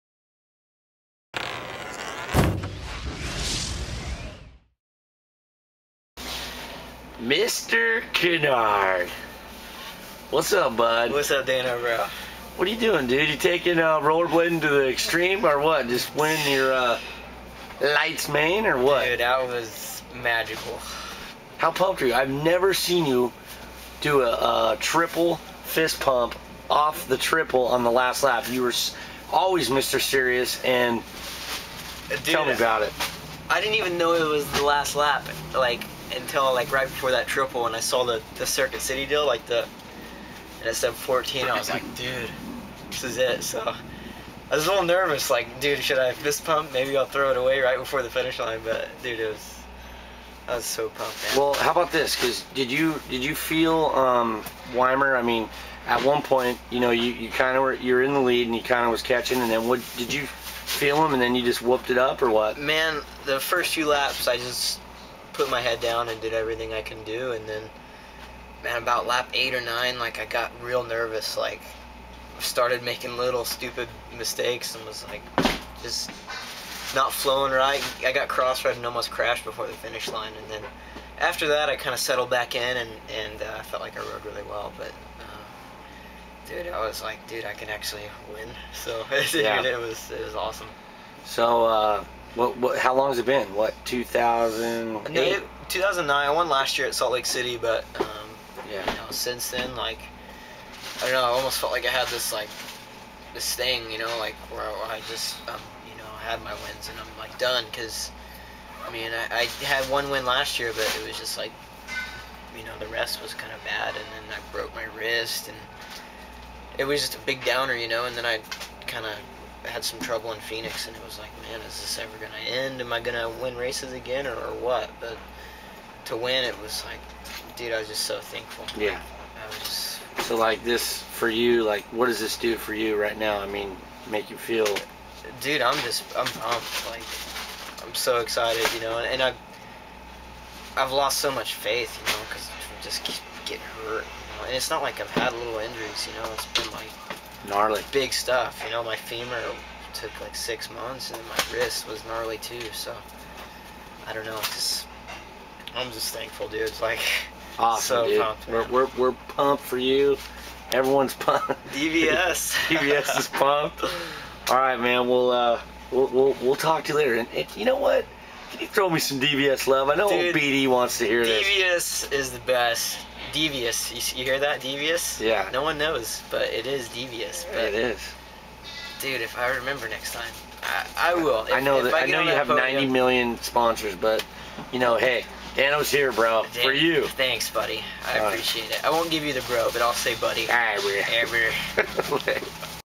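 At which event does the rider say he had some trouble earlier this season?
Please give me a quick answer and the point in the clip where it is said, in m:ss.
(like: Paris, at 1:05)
Phoenix, at 2:00.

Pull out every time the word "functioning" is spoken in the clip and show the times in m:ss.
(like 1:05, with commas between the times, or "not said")
not said.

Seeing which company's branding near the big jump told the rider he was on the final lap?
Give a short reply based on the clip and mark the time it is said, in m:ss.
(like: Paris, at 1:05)
Circuit City, at 0:38.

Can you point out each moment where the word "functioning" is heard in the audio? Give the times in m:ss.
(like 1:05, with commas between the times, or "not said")
not said.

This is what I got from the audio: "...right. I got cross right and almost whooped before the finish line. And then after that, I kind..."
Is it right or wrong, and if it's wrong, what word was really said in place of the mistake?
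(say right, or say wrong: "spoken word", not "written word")
wrong: "crashed", not "whooped".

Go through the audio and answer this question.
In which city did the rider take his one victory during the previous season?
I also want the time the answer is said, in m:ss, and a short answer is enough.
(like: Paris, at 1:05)
Salt Lake City, at 1:36.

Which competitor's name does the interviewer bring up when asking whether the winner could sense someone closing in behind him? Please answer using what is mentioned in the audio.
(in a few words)
Weimer.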